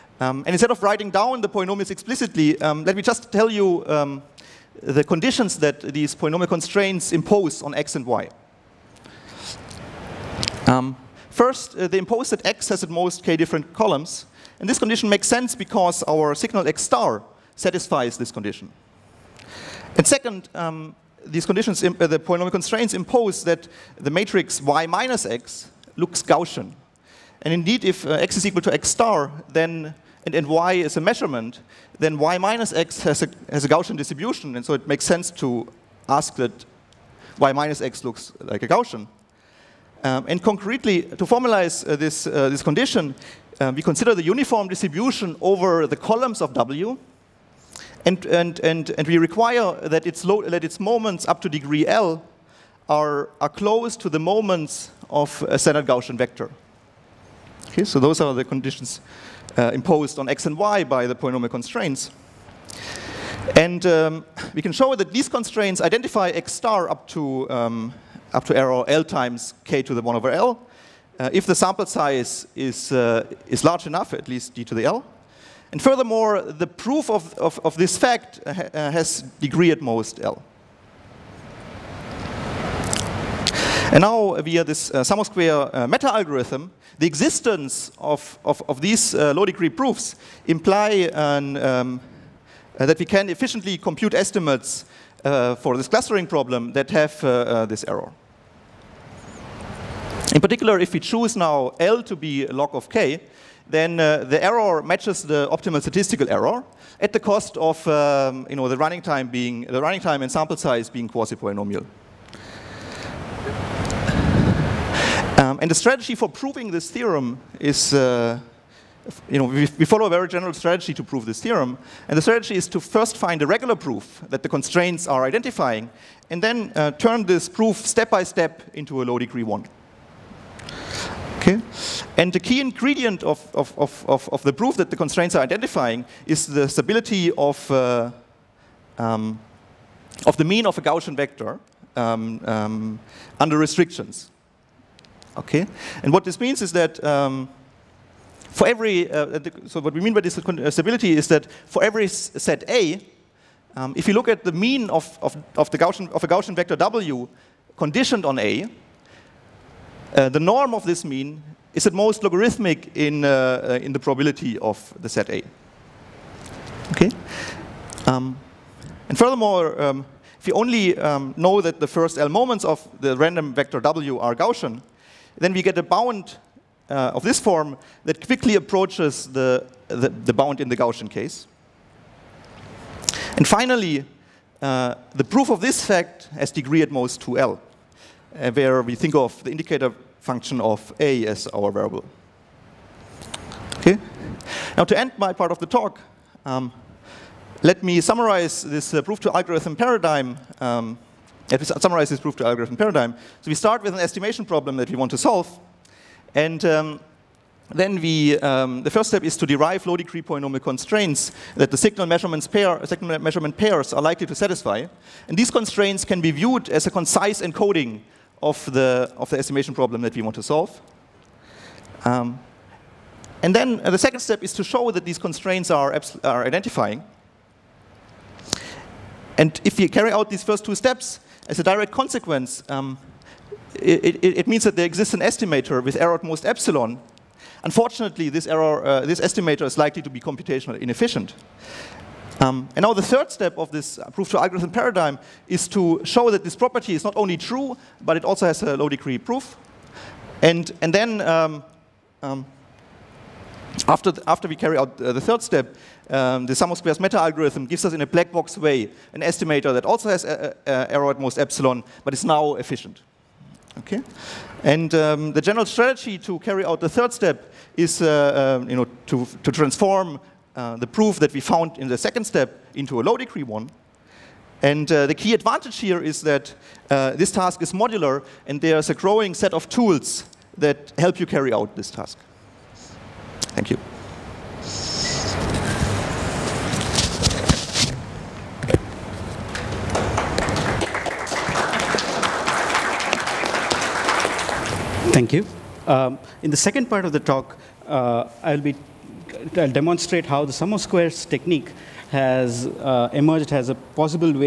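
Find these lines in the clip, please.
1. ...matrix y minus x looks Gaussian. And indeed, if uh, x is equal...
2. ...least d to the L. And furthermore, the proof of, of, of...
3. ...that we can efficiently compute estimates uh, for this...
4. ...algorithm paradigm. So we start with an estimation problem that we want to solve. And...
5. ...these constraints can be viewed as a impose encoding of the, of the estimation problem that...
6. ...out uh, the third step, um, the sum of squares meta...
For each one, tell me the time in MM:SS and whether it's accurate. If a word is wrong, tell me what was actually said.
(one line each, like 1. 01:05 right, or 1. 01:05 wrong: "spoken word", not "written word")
1. 00:24 right
2. 01:14 right
3. 01:32 right
4. 03:22 right
5. 03:35 wrong: "concise", not "impose"
6. 04:14 right.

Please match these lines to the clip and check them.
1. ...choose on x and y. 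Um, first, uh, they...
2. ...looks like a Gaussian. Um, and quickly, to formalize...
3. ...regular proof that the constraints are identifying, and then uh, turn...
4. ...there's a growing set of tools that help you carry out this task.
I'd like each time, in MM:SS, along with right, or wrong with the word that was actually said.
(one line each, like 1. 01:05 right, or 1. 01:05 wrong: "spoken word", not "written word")
1. 00:07 wrong: "impose", not "choose"
2. 00:38 wrong: "concretely", not "quickly"
3. 02:03 right
4. 04:38 right.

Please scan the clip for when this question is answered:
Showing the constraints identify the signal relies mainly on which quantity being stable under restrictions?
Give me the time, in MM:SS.
02:20.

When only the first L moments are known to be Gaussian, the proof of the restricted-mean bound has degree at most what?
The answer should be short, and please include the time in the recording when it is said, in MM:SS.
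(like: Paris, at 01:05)
2L, at 03:07.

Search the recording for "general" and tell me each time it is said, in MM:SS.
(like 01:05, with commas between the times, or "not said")
02:00, 04:25.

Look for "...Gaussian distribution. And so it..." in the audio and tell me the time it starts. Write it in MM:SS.
00:33.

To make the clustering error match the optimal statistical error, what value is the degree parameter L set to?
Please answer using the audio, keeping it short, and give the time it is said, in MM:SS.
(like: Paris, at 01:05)
log of k, at 01:42.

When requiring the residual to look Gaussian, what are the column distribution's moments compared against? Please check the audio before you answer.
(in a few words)
standard Gaussian vector.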